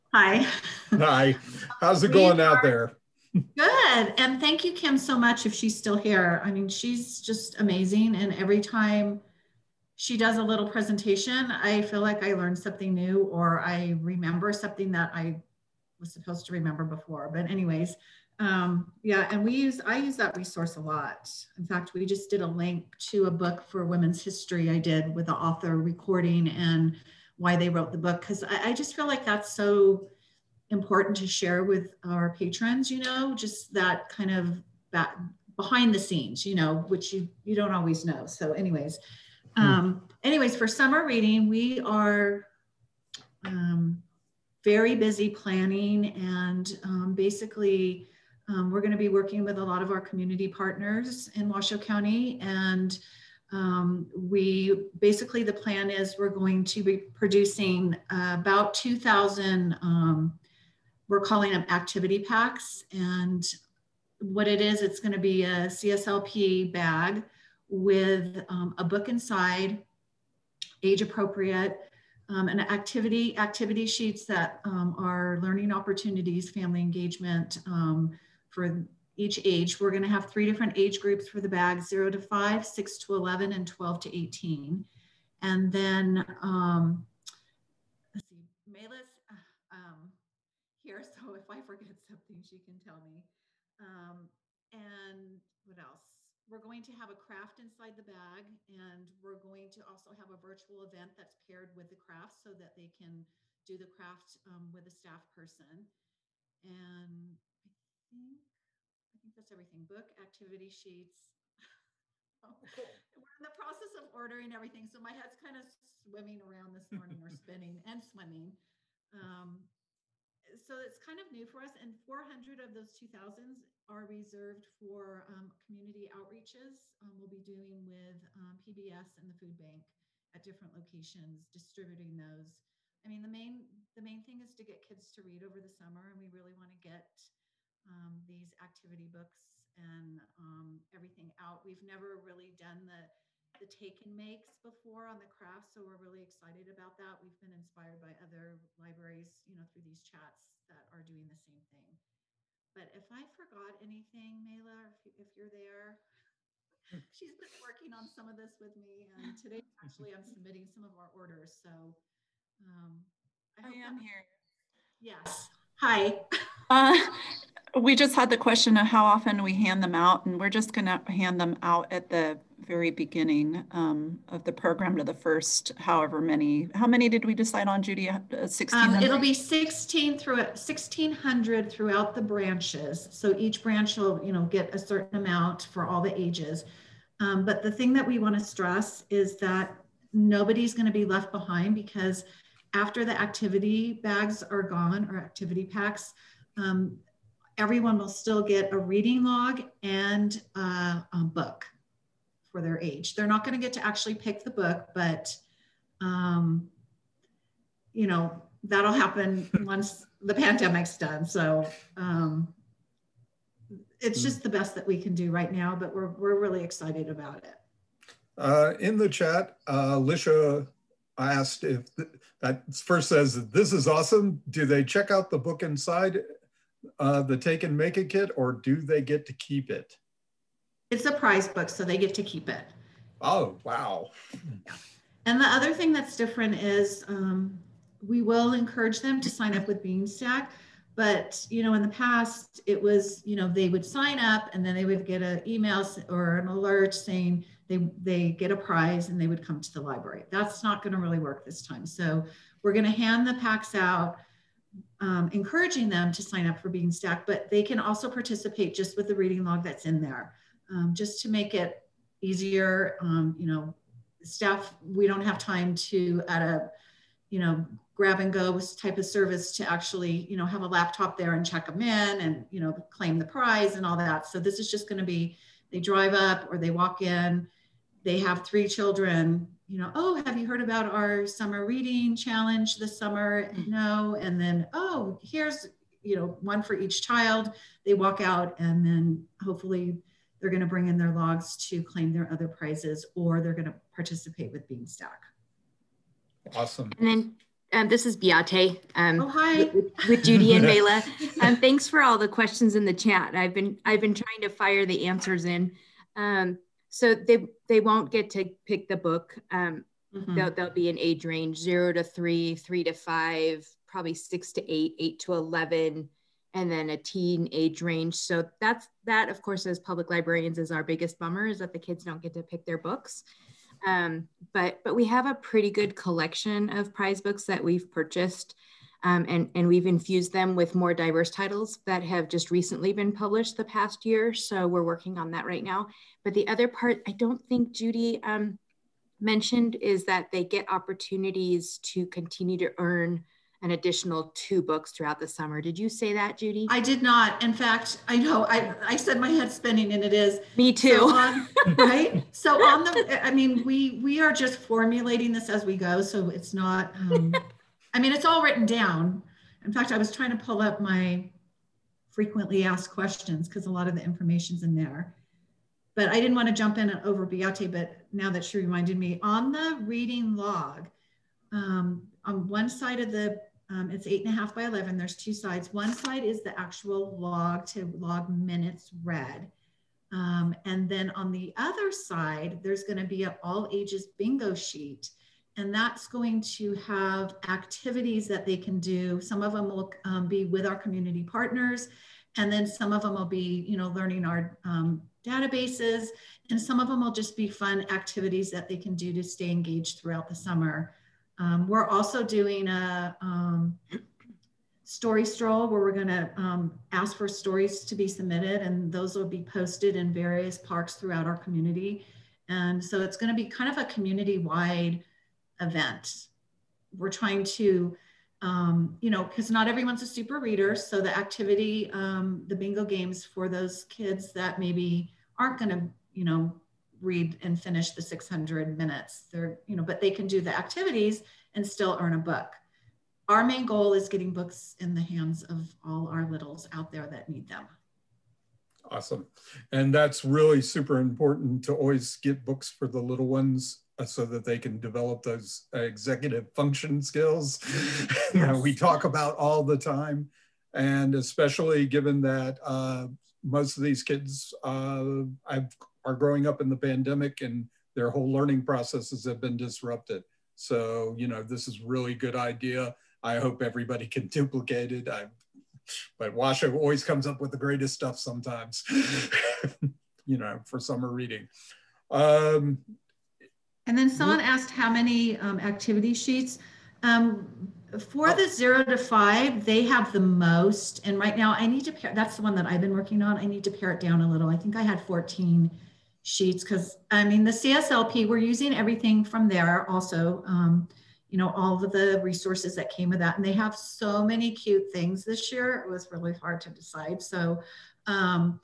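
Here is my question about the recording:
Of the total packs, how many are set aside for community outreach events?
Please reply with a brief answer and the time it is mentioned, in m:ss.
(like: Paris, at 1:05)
400, at 2:02.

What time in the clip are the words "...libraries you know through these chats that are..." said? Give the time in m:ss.
2:28.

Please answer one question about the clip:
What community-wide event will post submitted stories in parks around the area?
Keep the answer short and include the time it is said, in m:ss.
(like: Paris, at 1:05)
story stroll, at 6:44.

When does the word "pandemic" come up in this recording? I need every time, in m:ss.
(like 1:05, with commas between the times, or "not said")
3:30, 7:36.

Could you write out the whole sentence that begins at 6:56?
We're trying to, um, you know, because not everyone's a super reader.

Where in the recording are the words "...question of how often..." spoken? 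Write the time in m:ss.
2:48.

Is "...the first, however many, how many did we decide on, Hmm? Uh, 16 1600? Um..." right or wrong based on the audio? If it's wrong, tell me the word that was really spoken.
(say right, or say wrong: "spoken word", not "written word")
wrong: "Judy", not "Hmm".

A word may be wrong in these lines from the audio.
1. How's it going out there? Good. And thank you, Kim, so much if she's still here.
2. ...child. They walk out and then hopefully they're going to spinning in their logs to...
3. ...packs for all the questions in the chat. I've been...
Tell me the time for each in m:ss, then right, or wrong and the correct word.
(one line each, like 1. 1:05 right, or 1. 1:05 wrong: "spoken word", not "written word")
1. 0:01 right
2. 4:47 wrong: "bring", not "spinning"
3. 5:01 wrong: "thanks", not "packs".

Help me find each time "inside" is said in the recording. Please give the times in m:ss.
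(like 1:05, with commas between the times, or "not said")
1:09, 1:37, 3:45.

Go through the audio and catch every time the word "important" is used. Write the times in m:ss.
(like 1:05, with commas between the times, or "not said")
0:30, 7:20.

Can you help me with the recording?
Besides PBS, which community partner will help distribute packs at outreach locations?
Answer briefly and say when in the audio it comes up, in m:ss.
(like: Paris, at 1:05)
the food bank, at 2:09.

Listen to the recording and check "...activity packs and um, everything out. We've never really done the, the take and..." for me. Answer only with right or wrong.
wrong.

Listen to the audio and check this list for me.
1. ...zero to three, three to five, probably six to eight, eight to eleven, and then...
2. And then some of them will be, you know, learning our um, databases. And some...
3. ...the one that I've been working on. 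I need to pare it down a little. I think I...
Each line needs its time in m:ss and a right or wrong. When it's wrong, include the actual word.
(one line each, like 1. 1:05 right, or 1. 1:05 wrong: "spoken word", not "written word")
1. 5:11 right
2. 6:32 right
3. 8:02 right.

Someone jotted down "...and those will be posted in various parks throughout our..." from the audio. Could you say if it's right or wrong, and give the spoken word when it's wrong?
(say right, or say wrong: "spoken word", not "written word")
right.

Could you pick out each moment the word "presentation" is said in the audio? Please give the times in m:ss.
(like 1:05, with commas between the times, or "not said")
0:10.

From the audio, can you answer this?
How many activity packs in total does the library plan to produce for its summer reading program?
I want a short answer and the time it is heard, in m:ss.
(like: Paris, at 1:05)
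2,000, at 0:58.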